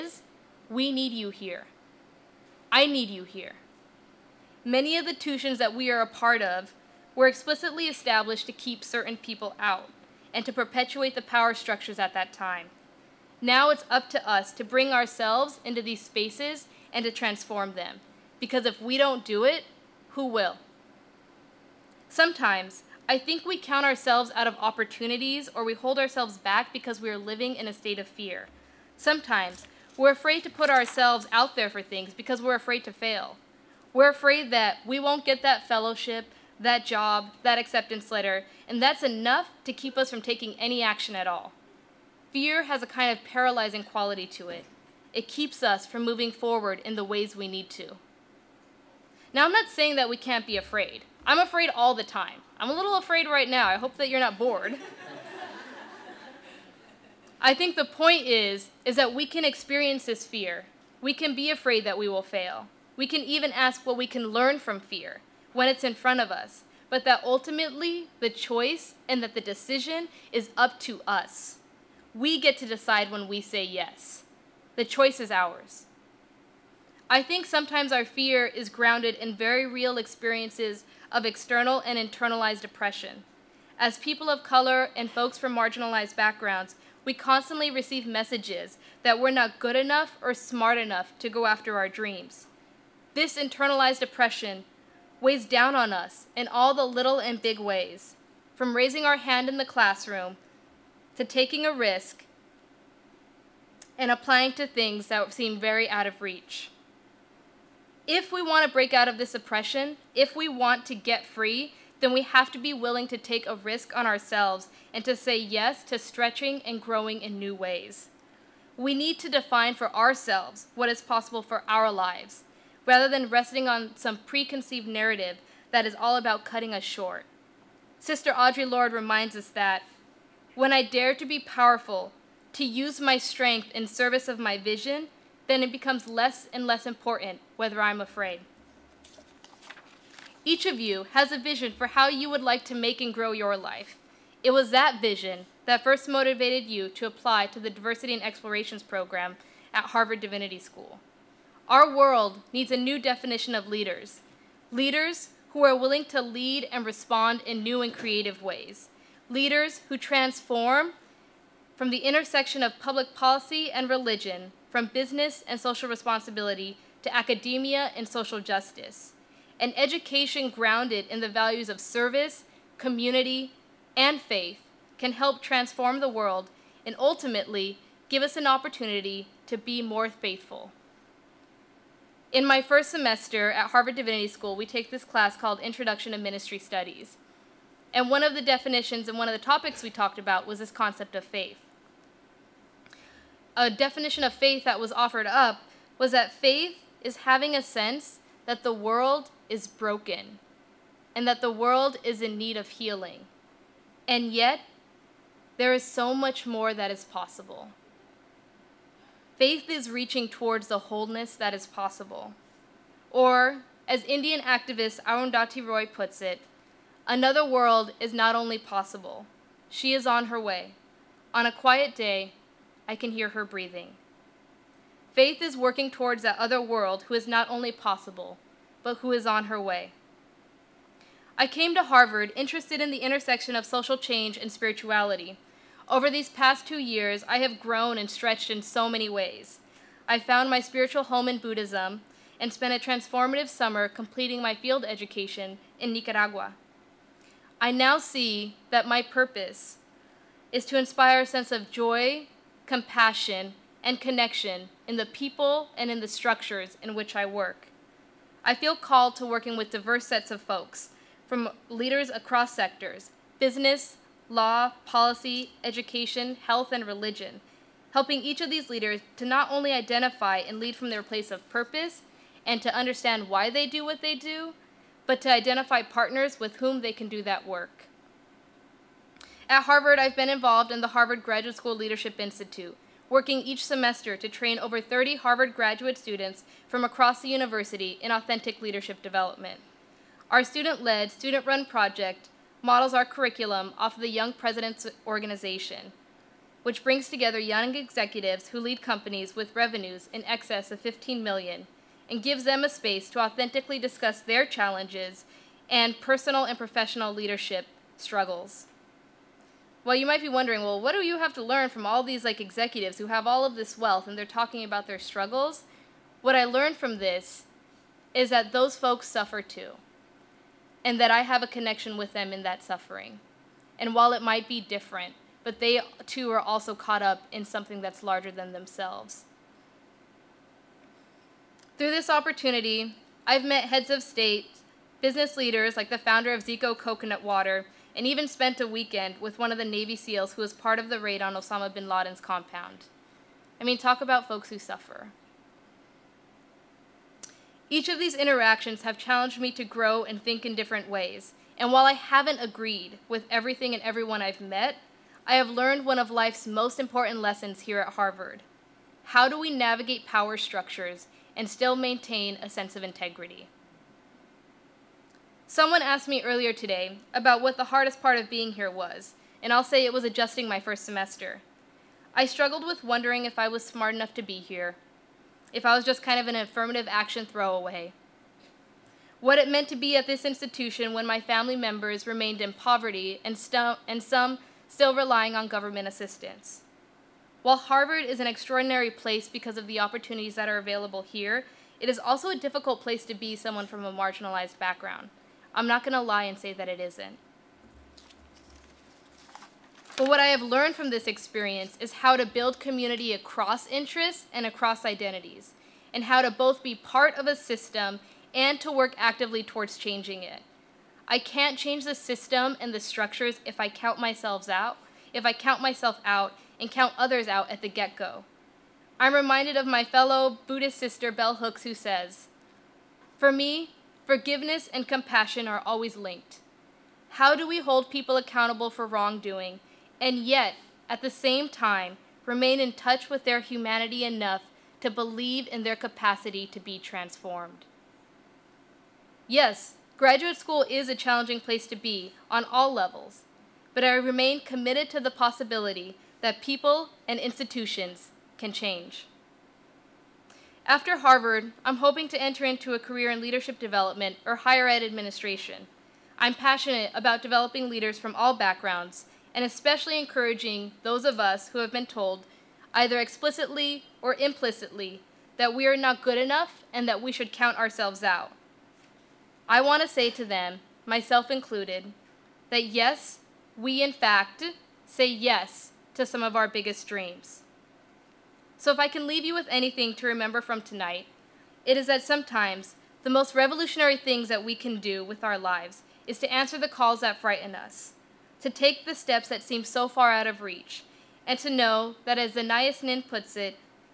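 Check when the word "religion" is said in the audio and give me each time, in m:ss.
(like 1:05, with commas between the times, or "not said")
2:43, 4:26.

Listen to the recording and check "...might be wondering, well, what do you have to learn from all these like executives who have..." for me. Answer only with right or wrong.
right.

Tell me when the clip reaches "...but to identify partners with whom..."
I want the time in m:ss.
4:35.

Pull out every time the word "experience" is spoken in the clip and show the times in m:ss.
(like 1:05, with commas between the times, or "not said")
0:59, 1:19, 6:41.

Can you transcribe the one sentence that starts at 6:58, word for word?
I'm reminded of my fellow Buddhist sister Bell Hooks, who says, For me, forgiveness and compassion are always linked.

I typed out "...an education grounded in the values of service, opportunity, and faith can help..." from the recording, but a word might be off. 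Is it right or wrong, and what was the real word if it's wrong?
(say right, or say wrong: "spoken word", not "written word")
wrong: "community", not "opportunity".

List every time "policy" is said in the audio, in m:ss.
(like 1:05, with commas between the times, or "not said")
2:43, 4:24.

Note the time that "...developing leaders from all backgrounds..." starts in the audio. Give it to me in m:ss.
7:37.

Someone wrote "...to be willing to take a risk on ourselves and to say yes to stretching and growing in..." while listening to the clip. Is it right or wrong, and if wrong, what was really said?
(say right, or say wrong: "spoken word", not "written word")
right.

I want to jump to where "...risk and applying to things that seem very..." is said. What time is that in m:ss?
1:41.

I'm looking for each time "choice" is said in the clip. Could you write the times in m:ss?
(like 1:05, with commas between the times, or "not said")
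1:08, 1:14.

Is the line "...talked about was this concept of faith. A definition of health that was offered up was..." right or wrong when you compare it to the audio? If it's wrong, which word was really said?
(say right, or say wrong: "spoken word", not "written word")
wrong: "faith", not "health".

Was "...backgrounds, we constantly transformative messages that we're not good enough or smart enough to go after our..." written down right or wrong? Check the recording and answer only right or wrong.
wrong.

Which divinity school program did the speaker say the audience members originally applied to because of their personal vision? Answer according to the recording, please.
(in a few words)
Diversity and Explorations program.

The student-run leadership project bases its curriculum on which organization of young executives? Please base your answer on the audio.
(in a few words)
Young Presidents Organization.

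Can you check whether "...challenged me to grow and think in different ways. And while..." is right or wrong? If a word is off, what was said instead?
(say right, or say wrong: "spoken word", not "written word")
right.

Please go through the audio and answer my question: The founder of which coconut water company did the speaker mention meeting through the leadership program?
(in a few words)
Zico.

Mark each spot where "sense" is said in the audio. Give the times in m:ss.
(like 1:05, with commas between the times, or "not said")
3:17, 4:11, 6:02.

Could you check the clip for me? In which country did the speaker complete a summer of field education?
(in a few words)
Nicaragua.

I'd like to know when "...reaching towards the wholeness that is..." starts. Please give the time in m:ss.
3:29.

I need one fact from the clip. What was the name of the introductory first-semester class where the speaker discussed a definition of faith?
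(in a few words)
Introduction to Ministry Studies.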